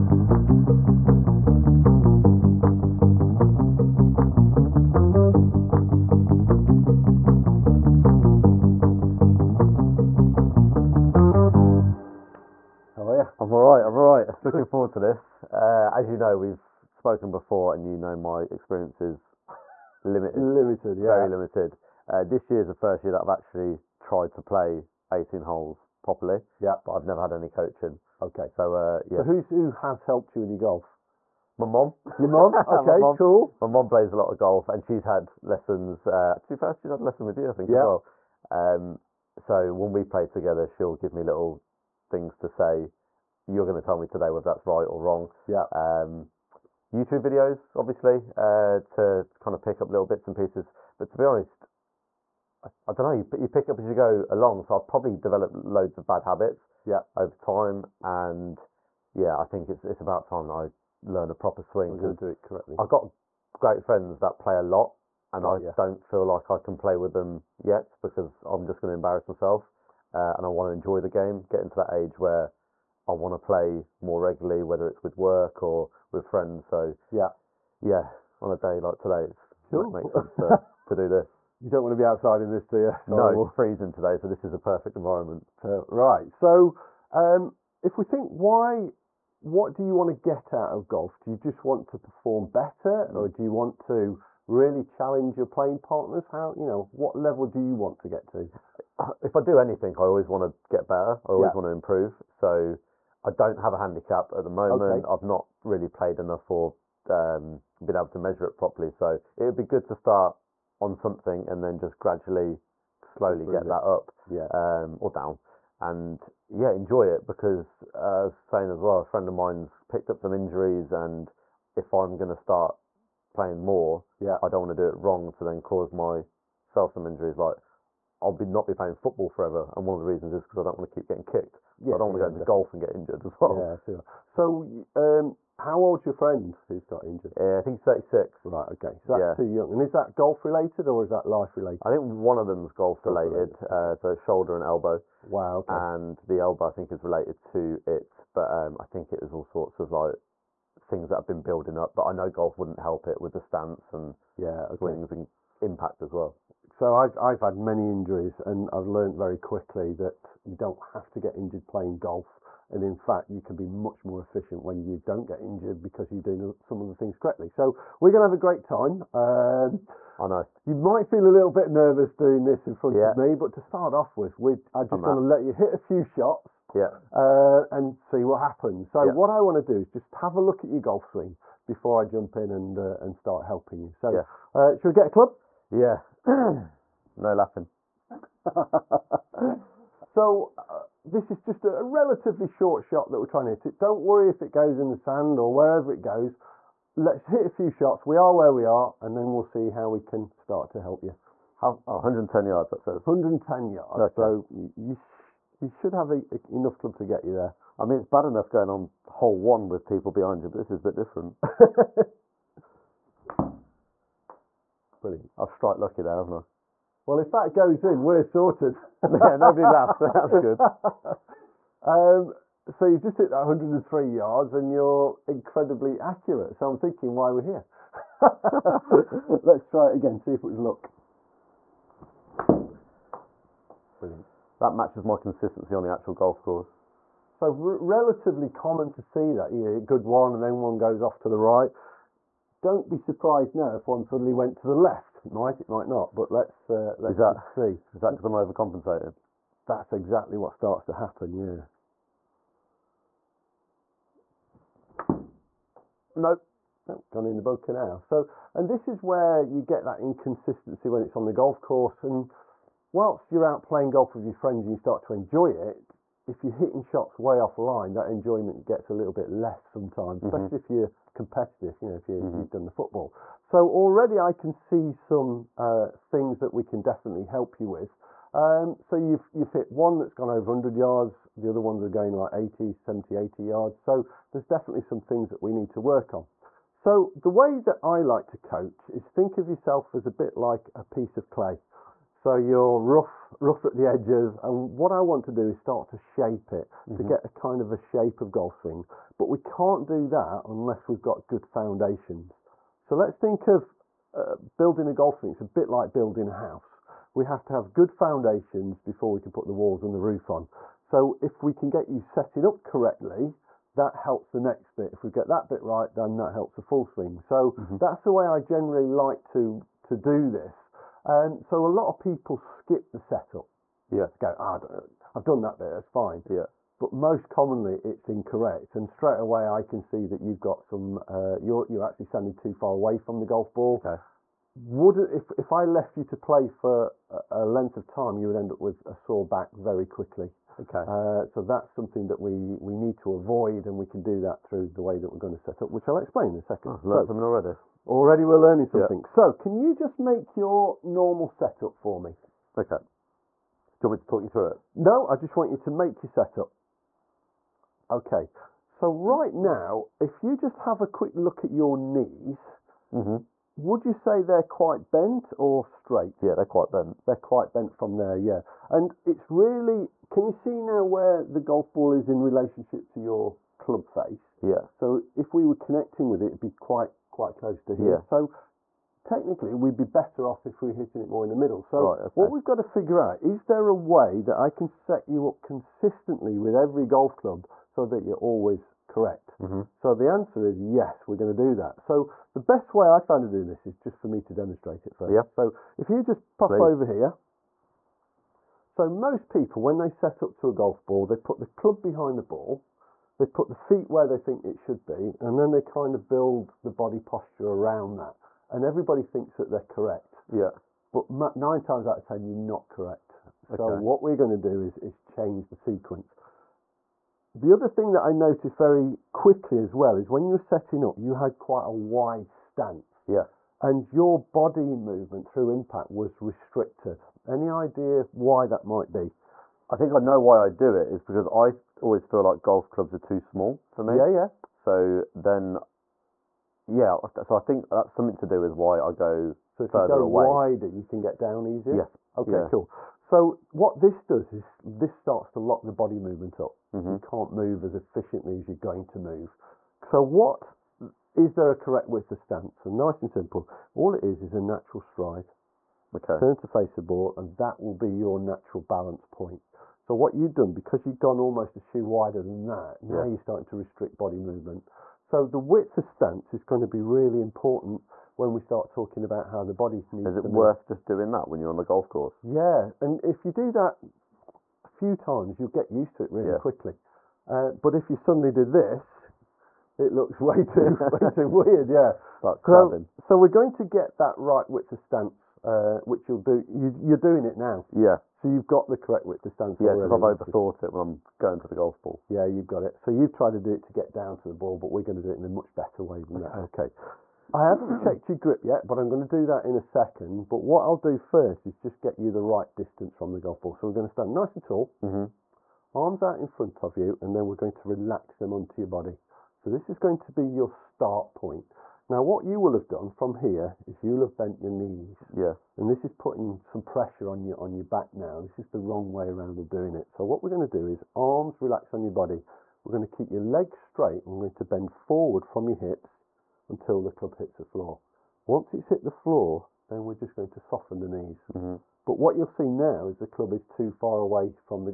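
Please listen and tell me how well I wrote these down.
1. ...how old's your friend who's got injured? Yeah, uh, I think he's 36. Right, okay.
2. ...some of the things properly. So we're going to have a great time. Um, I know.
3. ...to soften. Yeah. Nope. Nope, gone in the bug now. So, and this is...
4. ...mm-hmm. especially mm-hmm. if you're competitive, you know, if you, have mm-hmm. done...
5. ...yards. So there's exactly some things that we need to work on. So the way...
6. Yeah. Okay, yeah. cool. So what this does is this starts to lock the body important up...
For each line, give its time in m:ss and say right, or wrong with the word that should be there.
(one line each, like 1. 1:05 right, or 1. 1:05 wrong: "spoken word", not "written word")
1. 2:15 right
2. 2:46 wrong: "correctly", not "properly"
3. 4:10 wrong: "happen", not "soften"
4. 4:30 right
5. 4:43 wrong: "definitely", not "exactly"
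6. 7:21 wrong: "movement", not "important".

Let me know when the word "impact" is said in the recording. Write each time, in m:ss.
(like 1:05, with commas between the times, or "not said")
2:35, 7:05.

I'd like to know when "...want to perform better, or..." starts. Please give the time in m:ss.
1:31.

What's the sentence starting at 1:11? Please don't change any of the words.
Get into that age where I want to play more regularly, whether it's with work or with friends.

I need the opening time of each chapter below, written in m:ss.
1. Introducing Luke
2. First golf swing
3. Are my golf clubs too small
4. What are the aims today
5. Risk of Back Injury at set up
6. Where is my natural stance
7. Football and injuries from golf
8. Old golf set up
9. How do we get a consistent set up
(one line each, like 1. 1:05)
1. 0:17
2. 3:07
3. 7:17
4. 1:30
5. 5:39
6. 7:39
7. 2:11
8. 5:53
9. 6:29.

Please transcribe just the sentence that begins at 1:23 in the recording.
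no, it's freezing today, so this is a perfect environment.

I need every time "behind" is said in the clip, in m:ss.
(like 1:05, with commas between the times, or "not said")
3:30, 6:41.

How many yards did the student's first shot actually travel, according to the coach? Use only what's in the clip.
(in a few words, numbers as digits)
103.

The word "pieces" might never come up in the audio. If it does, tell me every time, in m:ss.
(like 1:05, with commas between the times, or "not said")
0:50, 4:50.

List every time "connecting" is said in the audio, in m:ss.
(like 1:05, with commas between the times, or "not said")
6:15.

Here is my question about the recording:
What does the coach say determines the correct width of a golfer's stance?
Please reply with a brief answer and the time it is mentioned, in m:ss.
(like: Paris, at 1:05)
A natural stride, at 7:34.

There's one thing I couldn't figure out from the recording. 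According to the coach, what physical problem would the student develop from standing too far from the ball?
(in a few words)
A sore back.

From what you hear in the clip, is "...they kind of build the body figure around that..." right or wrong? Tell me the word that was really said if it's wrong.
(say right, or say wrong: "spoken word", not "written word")
wrong: "posture", not "figure".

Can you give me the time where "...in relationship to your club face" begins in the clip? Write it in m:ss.
6:12.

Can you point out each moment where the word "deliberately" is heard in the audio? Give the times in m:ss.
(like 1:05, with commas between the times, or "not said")
not said.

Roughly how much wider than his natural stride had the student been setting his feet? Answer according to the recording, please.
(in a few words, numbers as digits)
Almost a shoe.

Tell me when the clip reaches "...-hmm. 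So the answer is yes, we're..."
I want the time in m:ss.
6:29.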